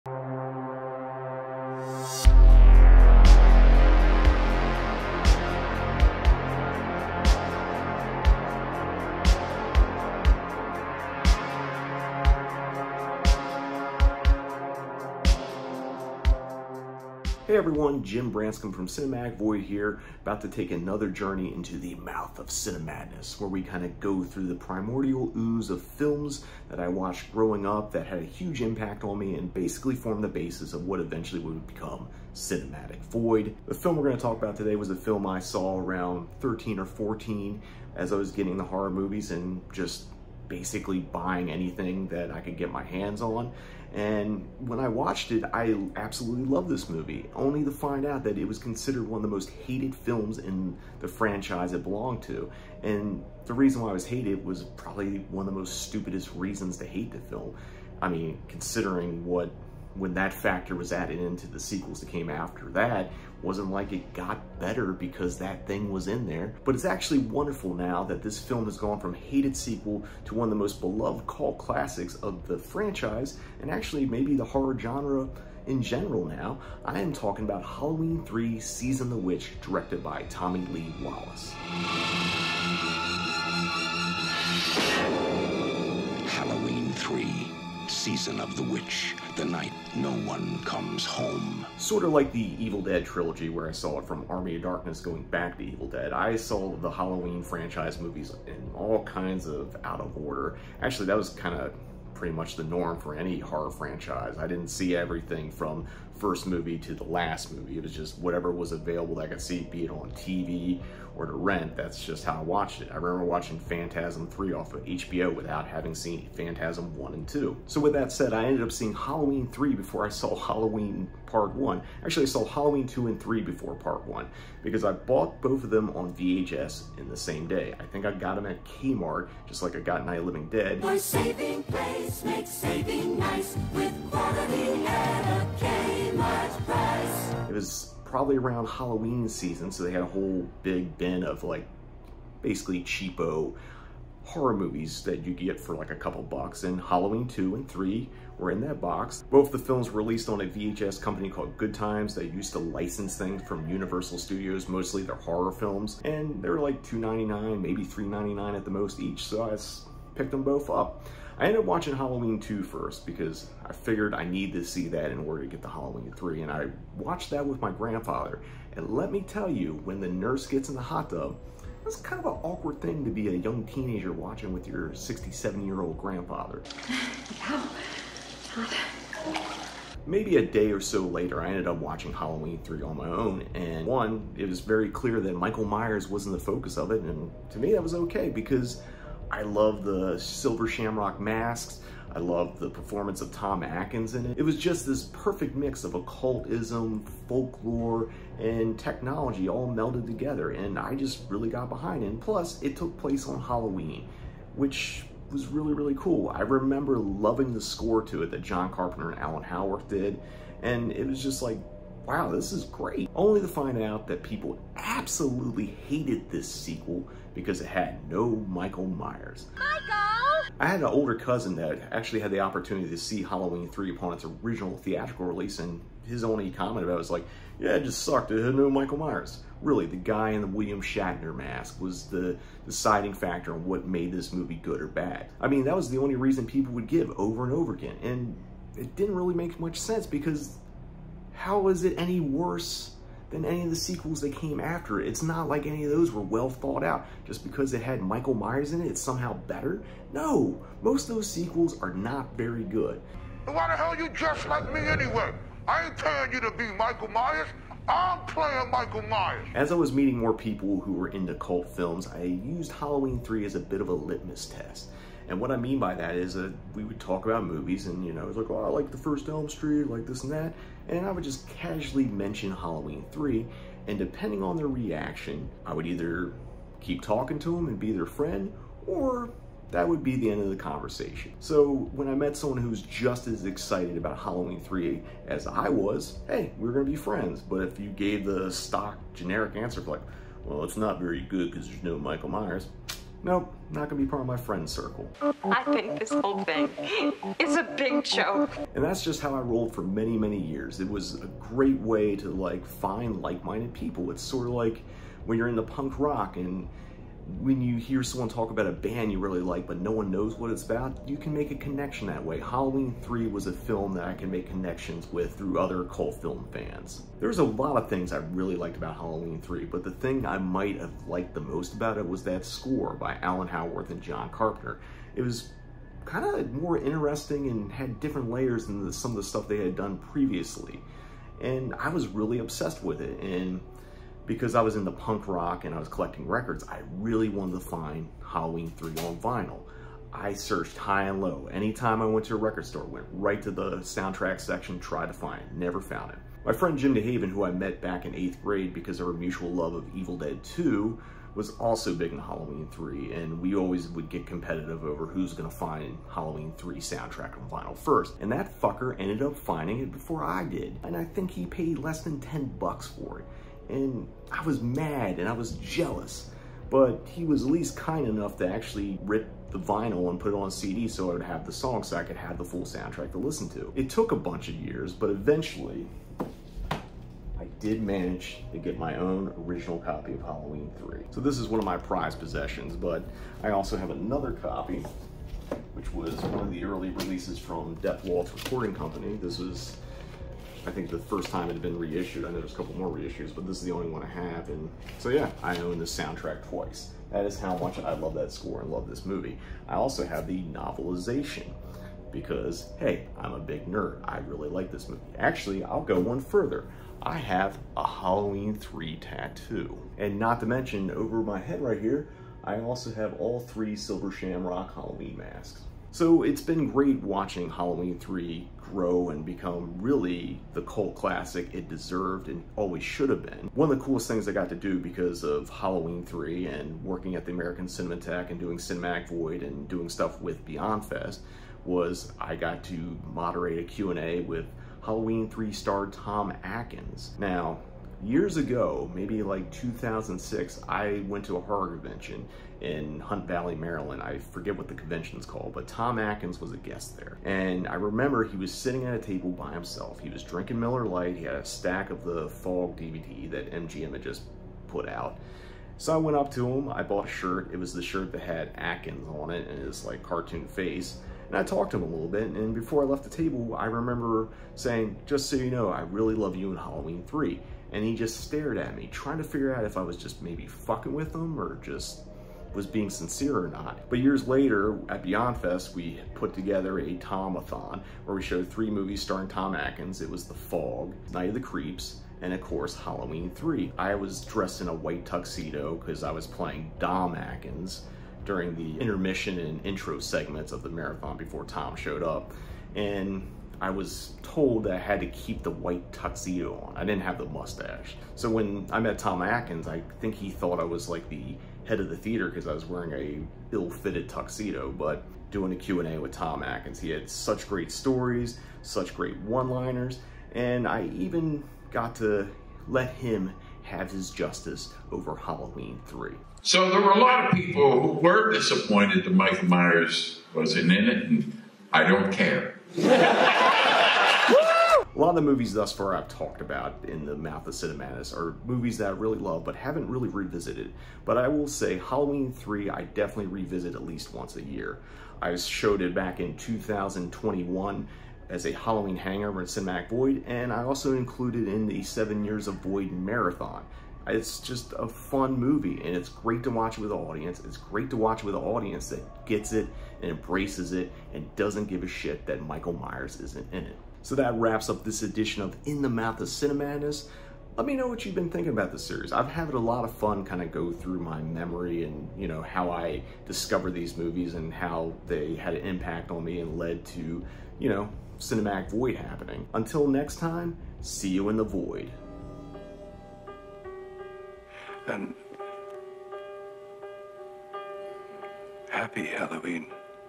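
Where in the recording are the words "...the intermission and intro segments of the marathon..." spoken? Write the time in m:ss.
8:08.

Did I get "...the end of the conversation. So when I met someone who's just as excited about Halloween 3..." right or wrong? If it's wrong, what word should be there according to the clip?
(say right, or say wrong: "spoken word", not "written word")
right.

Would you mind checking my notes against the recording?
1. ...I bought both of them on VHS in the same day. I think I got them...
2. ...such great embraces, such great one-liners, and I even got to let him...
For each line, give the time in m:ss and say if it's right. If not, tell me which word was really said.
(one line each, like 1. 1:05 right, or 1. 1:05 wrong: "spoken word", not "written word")
1. 2:04 right
2. 8:27 wrong: "stories", not "embraces".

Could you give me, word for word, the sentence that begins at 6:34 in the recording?
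And so yeah, I own the soundtrack twice.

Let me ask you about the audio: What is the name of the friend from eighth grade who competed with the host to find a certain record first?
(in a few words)
Jim DeHaven.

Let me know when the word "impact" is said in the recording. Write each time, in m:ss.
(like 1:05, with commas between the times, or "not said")
0:28, 9:25.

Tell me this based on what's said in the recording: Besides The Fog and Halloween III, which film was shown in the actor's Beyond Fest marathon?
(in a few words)
Night of the Creeps.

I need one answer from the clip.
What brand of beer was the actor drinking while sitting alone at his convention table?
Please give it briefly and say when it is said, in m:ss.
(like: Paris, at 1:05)
Miller Lite, at 7:30.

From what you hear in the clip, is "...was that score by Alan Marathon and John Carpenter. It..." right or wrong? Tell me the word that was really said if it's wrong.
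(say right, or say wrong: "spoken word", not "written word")
wrong: "Howarth", not "Marathon".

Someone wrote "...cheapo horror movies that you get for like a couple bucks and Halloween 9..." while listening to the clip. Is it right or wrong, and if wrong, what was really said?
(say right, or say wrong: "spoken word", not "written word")
wrong: "2", not "9".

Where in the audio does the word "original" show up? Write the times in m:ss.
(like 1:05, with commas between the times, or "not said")
3:44, 6:19.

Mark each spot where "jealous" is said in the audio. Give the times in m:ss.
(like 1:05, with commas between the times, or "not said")
6:05.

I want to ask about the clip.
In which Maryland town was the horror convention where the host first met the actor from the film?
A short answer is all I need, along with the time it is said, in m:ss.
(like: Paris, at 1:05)
Hunt Valley, at 7:22.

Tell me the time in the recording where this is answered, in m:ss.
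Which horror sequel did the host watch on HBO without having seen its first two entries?
1:53.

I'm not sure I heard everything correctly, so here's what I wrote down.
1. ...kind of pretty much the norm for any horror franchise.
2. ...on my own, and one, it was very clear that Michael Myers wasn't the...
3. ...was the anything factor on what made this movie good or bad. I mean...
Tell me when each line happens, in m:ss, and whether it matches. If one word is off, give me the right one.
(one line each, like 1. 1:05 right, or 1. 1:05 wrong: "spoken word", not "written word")
1. 1:41 right
2. 3:02 right
3. 3:51 wrong: "deciding", not "anything".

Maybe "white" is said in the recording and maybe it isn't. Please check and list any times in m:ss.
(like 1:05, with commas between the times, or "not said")
8:04, 8:15.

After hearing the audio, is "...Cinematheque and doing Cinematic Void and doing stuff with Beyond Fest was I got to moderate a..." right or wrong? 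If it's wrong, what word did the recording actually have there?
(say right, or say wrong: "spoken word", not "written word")
right.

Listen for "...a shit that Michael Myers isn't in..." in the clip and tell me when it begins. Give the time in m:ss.
9:11.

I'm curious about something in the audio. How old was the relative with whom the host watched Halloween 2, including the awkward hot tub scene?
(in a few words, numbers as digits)
67.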